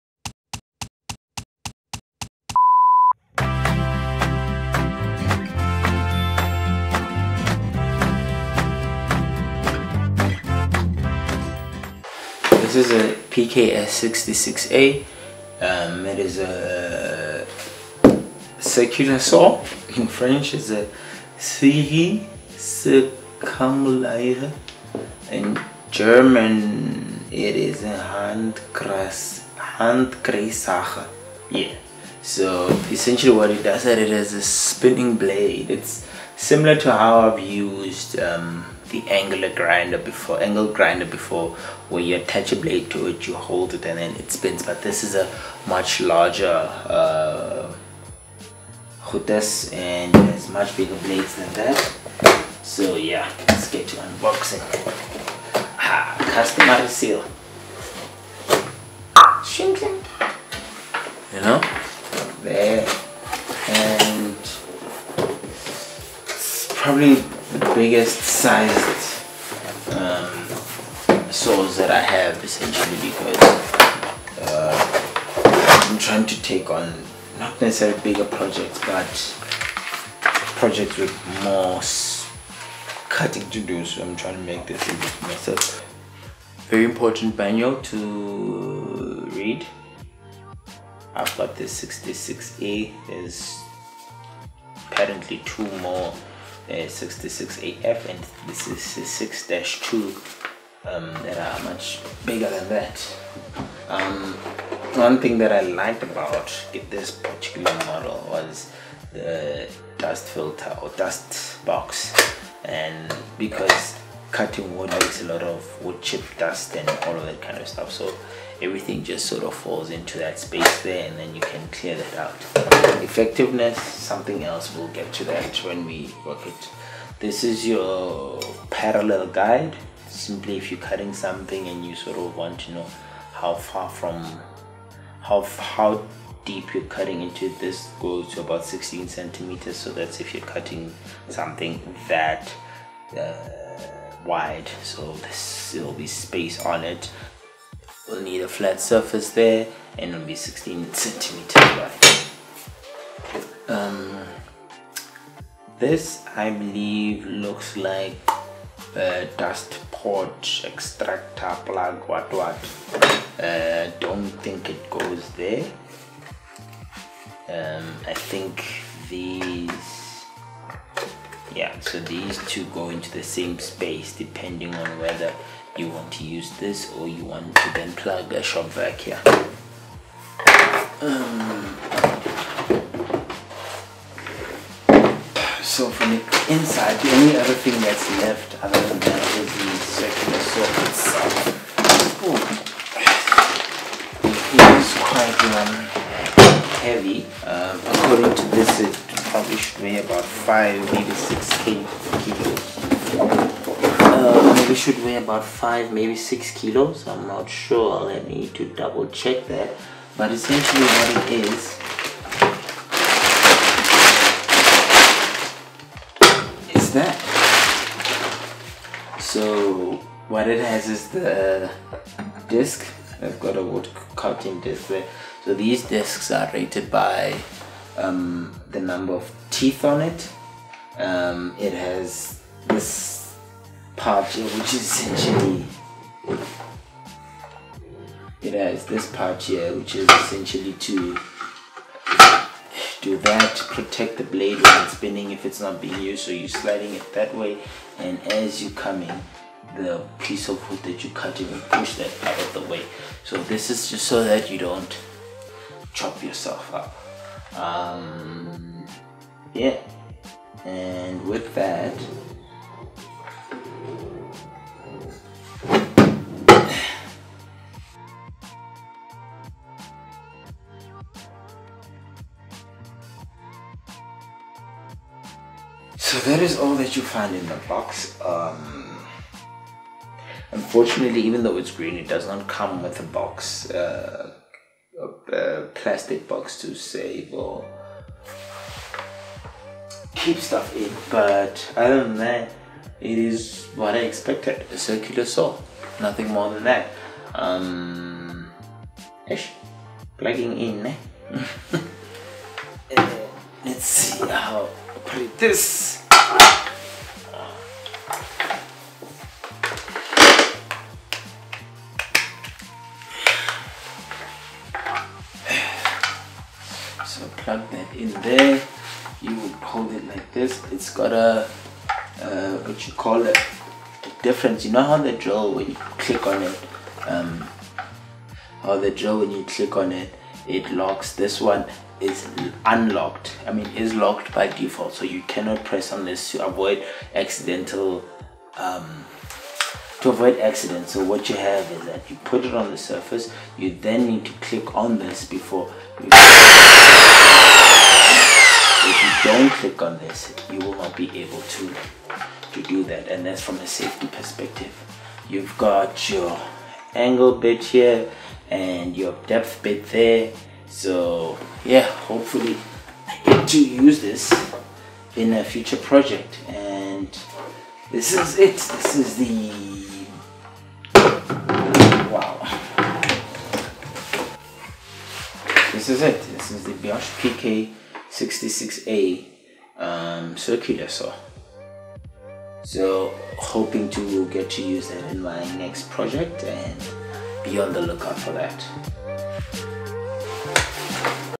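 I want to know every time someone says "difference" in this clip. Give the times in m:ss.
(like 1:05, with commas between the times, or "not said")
5:24.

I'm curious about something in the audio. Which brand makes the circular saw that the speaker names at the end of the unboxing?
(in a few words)
Bosch.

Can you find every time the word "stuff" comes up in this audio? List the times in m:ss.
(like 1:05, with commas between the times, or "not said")
1:57, 4:50.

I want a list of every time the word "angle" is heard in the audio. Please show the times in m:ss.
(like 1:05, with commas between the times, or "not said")
0:40, 5:56.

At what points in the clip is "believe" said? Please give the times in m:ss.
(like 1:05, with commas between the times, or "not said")
2:36.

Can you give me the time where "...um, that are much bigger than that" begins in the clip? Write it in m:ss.
1:40.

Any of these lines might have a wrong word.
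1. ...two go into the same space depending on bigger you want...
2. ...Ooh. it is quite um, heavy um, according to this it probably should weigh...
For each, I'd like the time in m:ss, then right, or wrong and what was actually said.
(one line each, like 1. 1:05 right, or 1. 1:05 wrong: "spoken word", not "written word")
1. 2:52 wrong: "whether", not "bigger"
2. 3:12 right.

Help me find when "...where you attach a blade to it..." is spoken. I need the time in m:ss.
0:41.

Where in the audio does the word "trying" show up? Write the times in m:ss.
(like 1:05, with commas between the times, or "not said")
1:15, 1:24.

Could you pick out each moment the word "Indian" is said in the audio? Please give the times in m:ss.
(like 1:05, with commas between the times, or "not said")
not said.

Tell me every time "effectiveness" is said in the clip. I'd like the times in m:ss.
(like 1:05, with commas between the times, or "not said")
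2:03.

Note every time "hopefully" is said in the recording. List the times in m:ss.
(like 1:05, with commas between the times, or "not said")
6:02.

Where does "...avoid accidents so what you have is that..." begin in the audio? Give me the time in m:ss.
5:40.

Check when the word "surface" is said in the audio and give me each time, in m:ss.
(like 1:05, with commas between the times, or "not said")
2:28, 5:42.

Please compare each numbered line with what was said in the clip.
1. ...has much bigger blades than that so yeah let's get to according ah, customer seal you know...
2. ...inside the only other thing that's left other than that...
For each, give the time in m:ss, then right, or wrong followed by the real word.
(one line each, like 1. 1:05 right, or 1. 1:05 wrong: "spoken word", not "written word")
1. 0:50 wrong: "unboxing", not "according"
2. 3:06 right.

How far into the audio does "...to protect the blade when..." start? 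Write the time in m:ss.
4:03.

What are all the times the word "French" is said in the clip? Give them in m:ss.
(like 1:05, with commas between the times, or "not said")
0:20.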